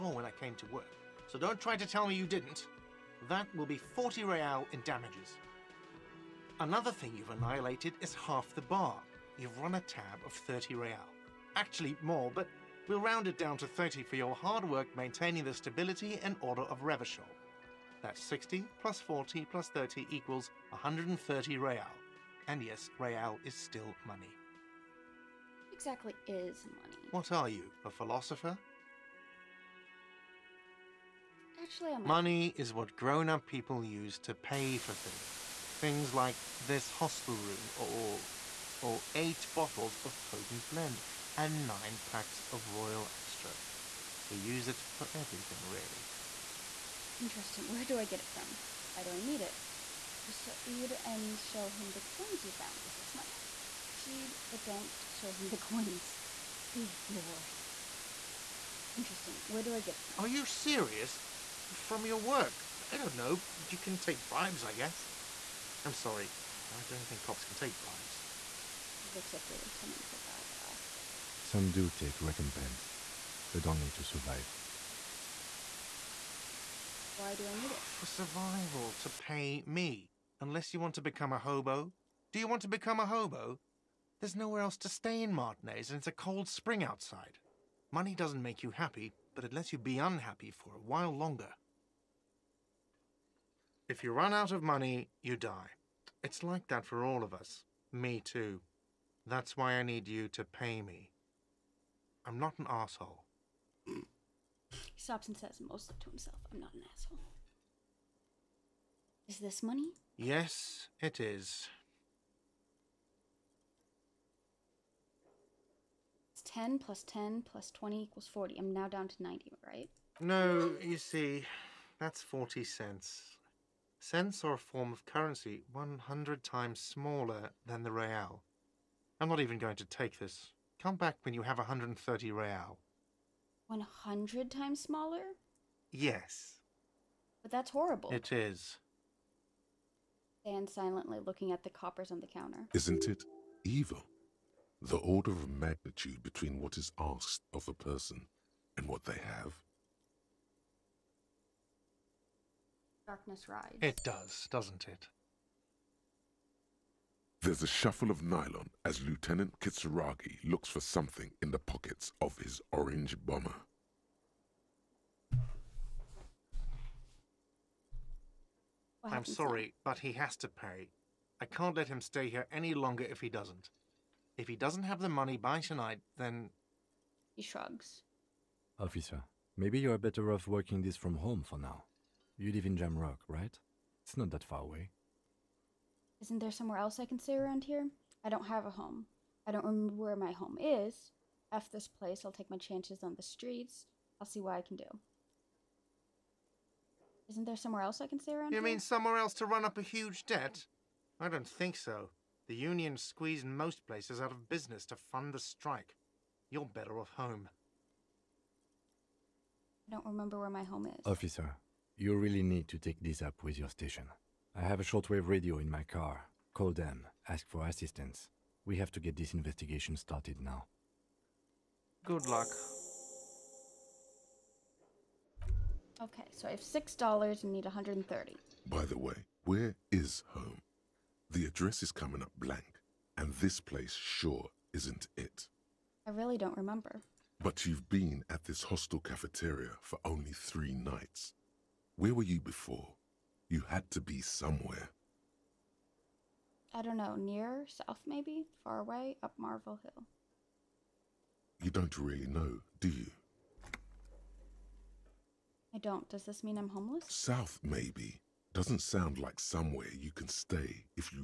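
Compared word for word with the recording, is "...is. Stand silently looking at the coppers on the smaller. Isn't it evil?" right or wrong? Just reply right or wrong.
wrong.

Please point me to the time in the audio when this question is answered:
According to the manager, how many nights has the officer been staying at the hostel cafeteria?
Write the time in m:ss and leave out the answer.
4:00.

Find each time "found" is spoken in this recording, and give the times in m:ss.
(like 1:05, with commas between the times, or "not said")
0:52.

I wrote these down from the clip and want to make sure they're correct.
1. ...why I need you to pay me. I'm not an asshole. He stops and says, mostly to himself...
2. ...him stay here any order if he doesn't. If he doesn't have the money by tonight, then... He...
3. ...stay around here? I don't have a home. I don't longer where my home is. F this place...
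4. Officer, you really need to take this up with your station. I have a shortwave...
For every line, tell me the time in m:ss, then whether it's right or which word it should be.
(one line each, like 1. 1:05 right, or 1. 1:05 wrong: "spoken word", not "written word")
1. 1:39 right
2. 2:51 wrong: "longer", not "order"
3. 3:07 wrong: "remember", not "longer"
4. 3:31 right.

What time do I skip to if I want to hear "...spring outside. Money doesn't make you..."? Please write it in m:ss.
1:26.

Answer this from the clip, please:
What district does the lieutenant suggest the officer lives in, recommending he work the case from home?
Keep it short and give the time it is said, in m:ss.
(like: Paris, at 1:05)
Jamrock, at 3:02.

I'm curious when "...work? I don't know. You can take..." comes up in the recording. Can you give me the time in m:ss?
1:02.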